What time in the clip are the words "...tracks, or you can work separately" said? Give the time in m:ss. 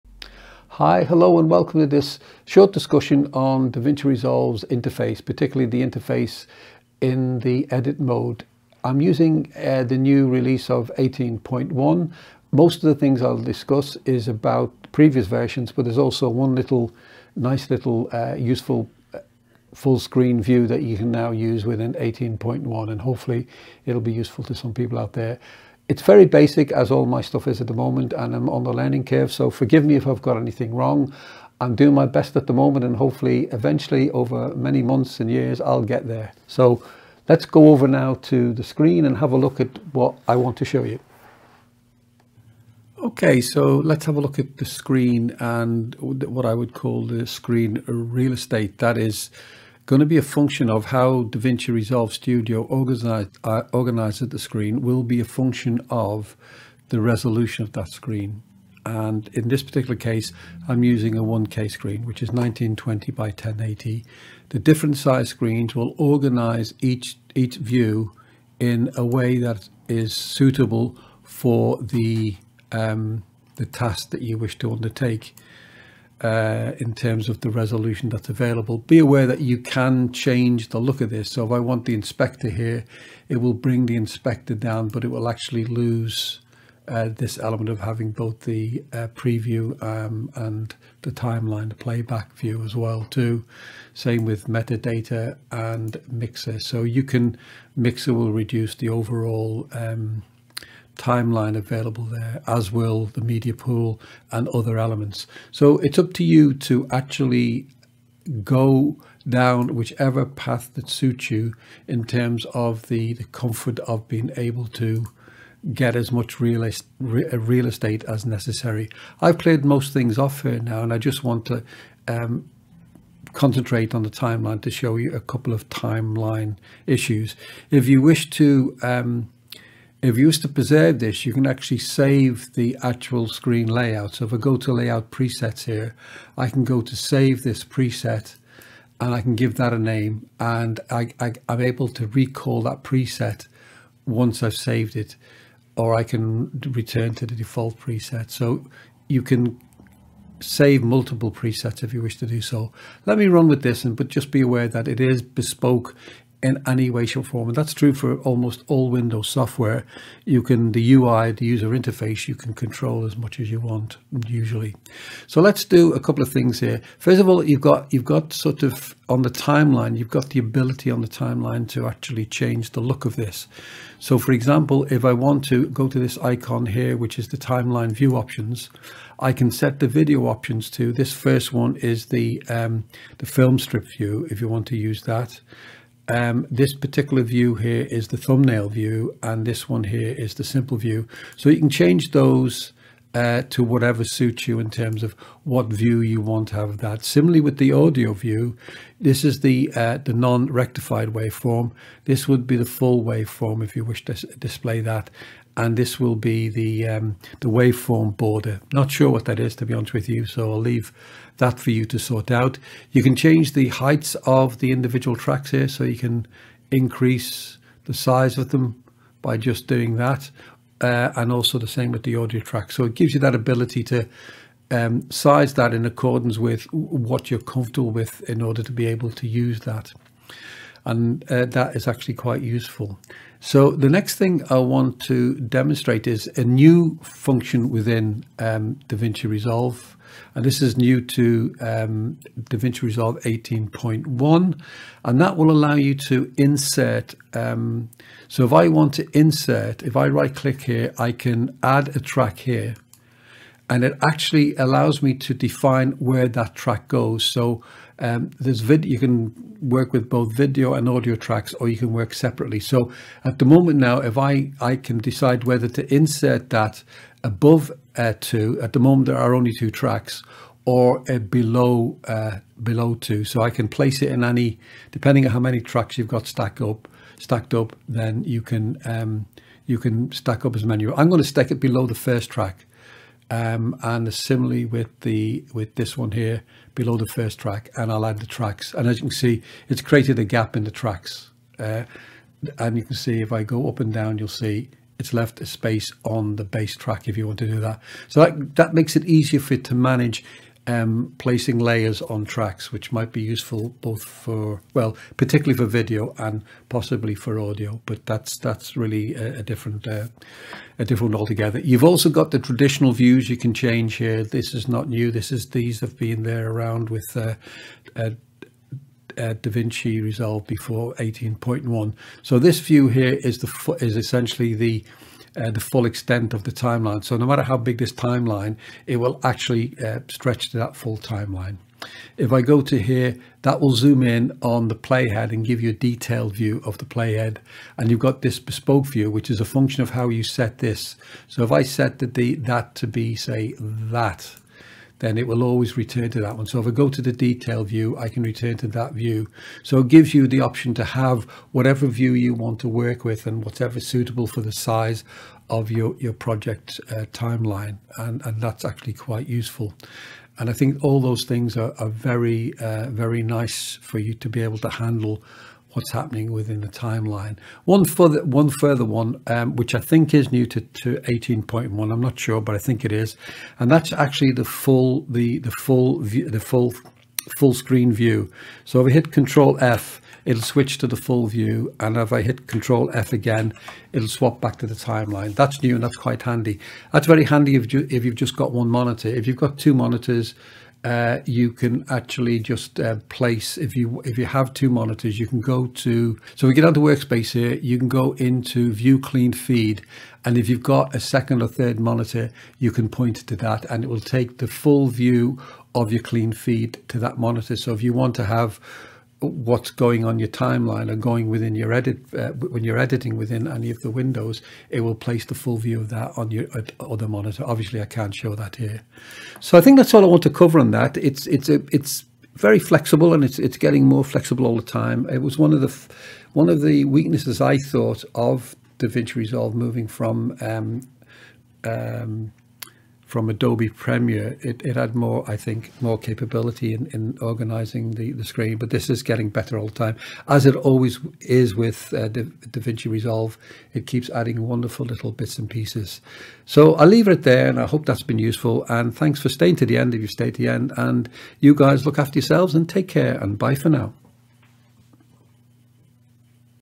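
4:21.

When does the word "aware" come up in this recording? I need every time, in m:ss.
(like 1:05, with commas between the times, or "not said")
1:18, 2:34.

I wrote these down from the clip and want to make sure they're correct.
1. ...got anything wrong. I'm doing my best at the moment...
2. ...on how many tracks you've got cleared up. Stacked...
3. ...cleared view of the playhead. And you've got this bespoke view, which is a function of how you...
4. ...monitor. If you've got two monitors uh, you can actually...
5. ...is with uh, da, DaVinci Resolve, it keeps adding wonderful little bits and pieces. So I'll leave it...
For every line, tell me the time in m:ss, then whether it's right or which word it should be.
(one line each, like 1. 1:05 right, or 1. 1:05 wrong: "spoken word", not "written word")
1. 0:30 right
2. 4:35 wrong: "stacked", not "cleared"
3. 5:35 wrong: "detailed", not "cleared"
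4. 6:28 right
5. 7:21 right.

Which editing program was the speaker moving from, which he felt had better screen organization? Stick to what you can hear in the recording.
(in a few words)
Adobe Premiere.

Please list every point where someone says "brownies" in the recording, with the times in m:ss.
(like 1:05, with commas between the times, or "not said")
not said.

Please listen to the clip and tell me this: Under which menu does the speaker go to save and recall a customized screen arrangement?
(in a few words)
layout presets.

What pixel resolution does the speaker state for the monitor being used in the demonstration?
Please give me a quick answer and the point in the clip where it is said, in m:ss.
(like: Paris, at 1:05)
1920 by 1080, at 1:02.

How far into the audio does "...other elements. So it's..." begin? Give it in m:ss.
1:44.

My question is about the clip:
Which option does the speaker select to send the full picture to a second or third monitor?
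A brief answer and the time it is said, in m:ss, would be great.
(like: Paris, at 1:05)
view clean feed, at 6:38.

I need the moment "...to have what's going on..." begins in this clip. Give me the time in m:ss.
6:48.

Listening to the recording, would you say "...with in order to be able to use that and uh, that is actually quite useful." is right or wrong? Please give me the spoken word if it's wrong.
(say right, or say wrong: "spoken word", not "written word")
right.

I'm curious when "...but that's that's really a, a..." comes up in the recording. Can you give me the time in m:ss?
5:07.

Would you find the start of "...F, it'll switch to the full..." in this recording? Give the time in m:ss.
6:19.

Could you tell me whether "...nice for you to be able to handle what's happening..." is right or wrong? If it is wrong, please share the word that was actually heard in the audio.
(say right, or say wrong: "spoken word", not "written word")
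right.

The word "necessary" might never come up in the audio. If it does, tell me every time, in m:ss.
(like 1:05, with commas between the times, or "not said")
1:58.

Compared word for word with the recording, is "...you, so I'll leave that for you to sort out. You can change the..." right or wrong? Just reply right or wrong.
right.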